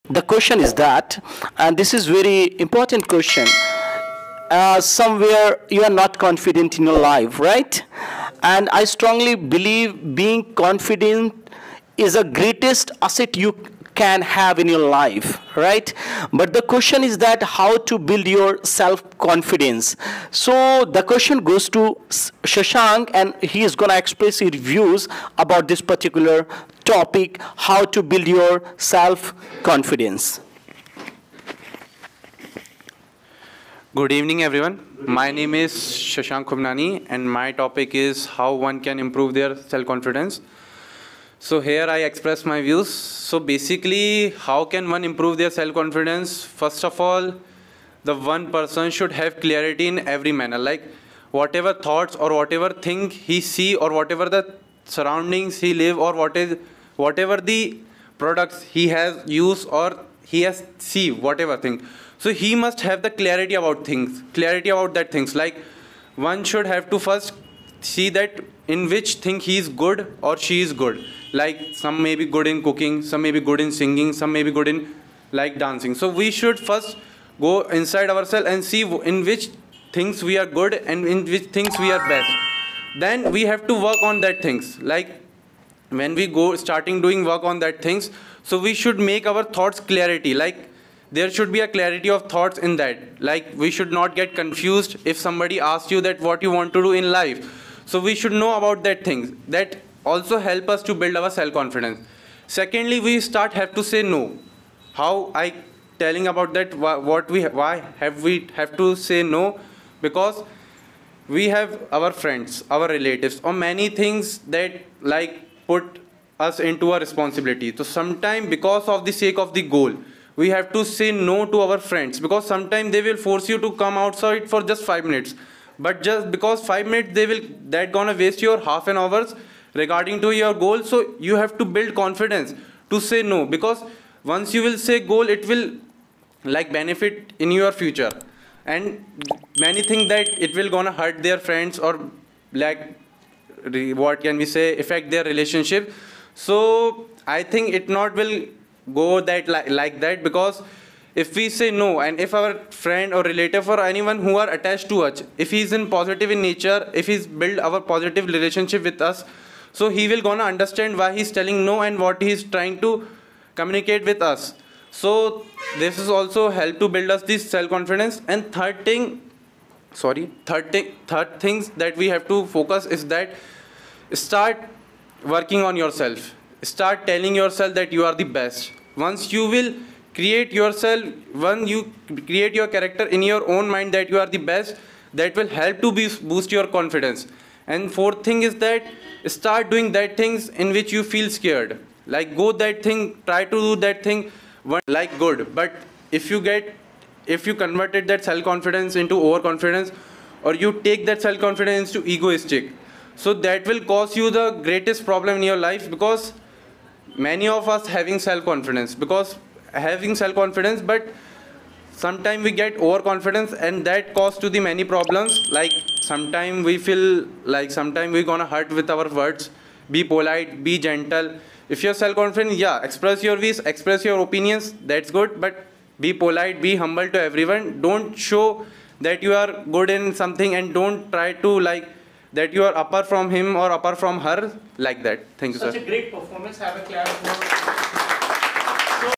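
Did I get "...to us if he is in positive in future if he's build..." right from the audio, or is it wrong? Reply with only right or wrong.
wrong.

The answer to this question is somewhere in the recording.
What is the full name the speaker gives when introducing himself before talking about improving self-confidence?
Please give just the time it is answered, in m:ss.
0:36.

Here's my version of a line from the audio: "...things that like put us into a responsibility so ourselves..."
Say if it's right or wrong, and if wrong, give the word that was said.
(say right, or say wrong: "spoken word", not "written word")
wrong: "sometimes", not "ourselves".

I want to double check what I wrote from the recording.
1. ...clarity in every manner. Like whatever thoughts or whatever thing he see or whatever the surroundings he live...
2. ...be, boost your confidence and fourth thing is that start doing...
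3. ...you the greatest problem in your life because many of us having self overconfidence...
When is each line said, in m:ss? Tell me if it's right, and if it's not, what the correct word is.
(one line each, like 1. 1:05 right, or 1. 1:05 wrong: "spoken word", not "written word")
1. 0:49 right
2. 3:05 right
3. 3:24 wrong: "confidence", not "overconfidence".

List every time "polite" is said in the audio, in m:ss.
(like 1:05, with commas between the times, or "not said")
3:40, 3:46.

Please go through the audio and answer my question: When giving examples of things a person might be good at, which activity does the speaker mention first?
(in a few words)
cooking.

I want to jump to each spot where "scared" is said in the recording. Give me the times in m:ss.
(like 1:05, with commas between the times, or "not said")
3:11.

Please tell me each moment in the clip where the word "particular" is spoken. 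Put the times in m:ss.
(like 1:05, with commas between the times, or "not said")
0:25.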